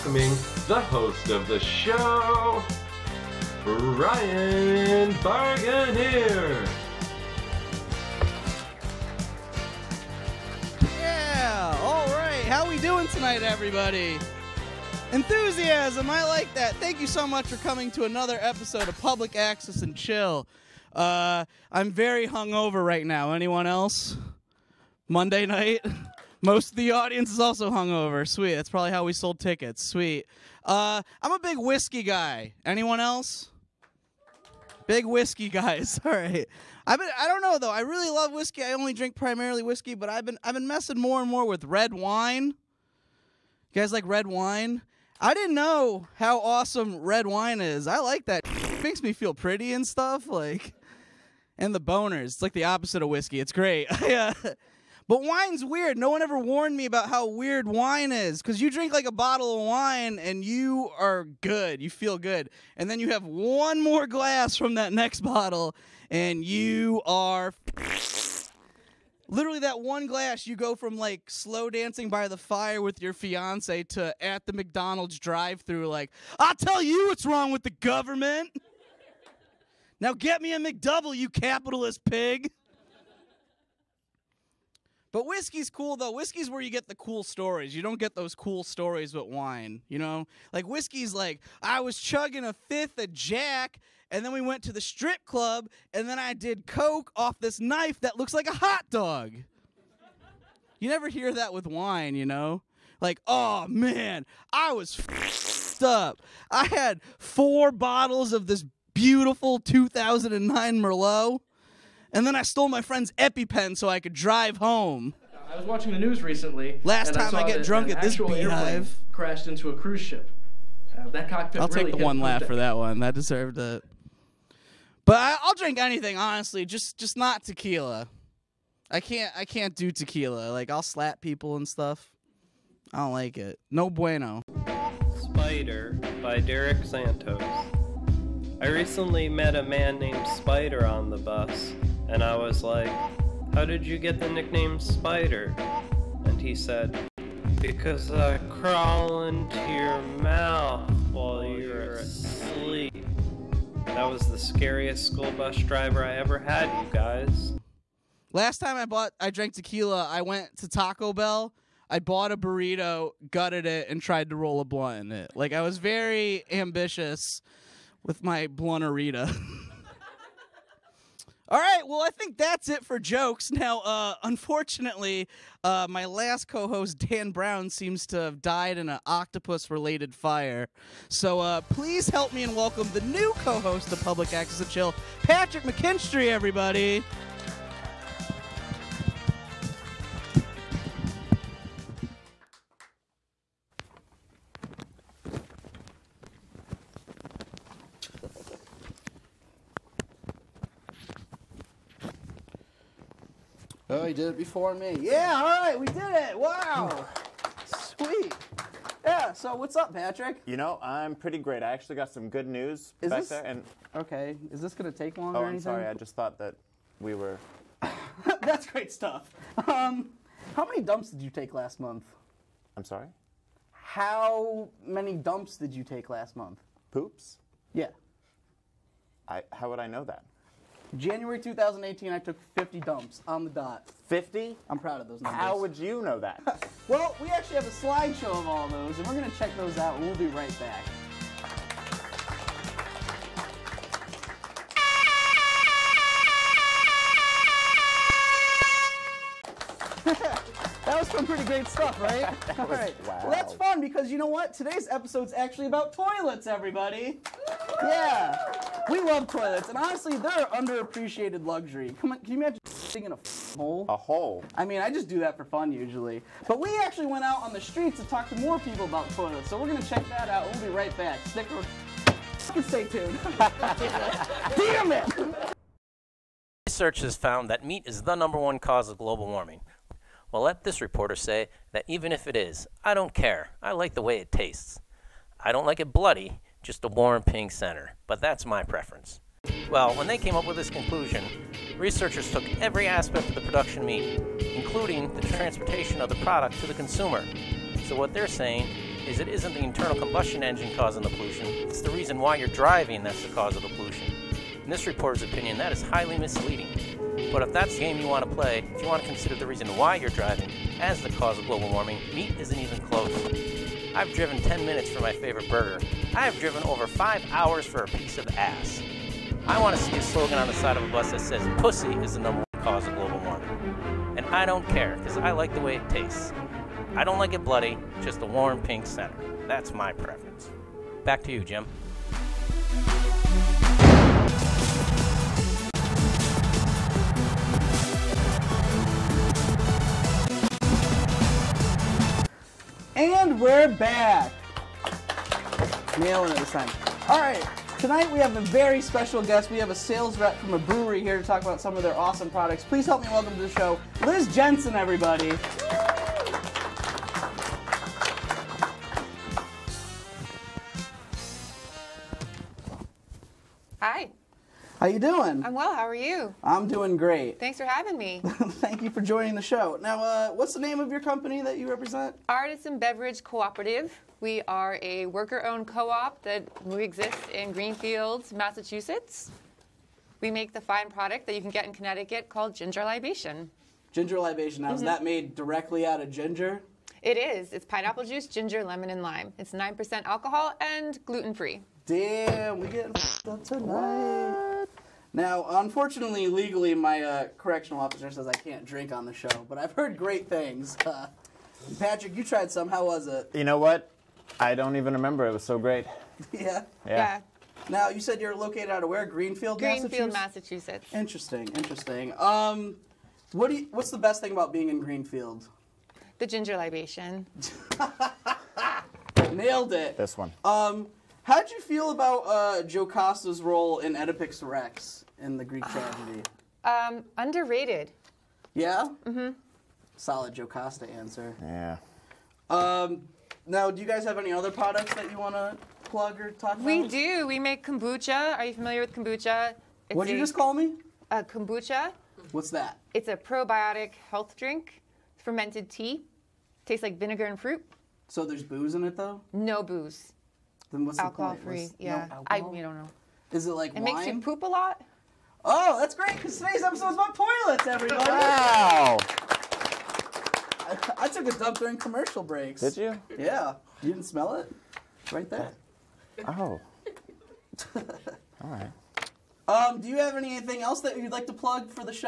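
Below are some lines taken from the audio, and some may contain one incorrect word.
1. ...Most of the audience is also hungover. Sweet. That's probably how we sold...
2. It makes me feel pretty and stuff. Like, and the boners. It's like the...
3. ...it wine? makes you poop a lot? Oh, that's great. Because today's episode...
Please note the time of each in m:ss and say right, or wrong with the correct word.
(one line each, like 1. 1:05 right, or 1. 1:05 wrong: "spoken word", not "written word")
1. 0:26 right
2. 0:48 right
3. 7:33 right.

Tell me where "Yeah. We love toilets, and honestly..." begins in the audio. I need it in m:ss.
4:17.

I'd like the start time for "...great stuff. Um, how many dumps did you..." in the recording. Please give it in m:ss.
3:38.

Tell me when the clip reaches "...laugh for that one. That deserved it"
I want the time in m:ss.
2:02.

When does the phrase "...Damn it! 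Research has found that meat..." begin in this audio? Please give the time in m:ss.
4:33.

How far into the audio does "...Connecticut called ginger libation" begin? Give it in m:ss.
6:21.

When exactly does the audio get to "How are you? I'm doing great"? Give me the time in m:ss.
6:05.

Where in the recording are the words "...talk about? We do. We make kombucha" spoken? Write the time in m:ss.
7:16.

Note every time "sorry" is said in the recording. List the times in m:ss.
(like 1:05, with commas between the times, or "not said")
3:35, 3:42.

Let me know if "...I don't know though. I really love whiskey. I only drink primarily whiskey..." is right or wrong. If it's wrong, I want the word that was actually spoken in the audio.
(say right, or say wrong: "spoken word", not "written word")
right.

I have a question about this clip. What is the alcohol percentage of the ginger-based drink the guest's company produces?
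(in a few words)
9%.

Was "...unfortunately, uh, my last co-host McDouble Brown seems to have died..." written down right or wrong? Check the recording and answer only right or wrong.
wrong.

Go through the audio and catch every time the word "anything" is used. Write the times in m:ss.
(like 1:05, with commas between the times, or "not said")
2:05, 7:50.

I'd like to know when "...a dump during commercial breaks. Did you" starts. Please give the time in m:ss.
7:41.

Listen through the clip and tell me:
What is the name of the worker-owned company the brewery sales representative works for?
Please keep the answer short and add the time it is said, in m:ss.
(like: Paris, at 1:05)
Artisan Beverage Cooperative, at 6:12.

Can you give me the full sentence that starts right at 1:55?
I was watching the news recently.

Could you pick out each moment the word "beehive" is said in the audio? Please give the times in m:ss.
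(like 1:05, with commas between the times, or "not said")
1:58.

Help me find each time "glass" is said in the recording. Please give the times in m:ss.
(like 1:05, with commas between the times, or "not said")
1:04, 1:10.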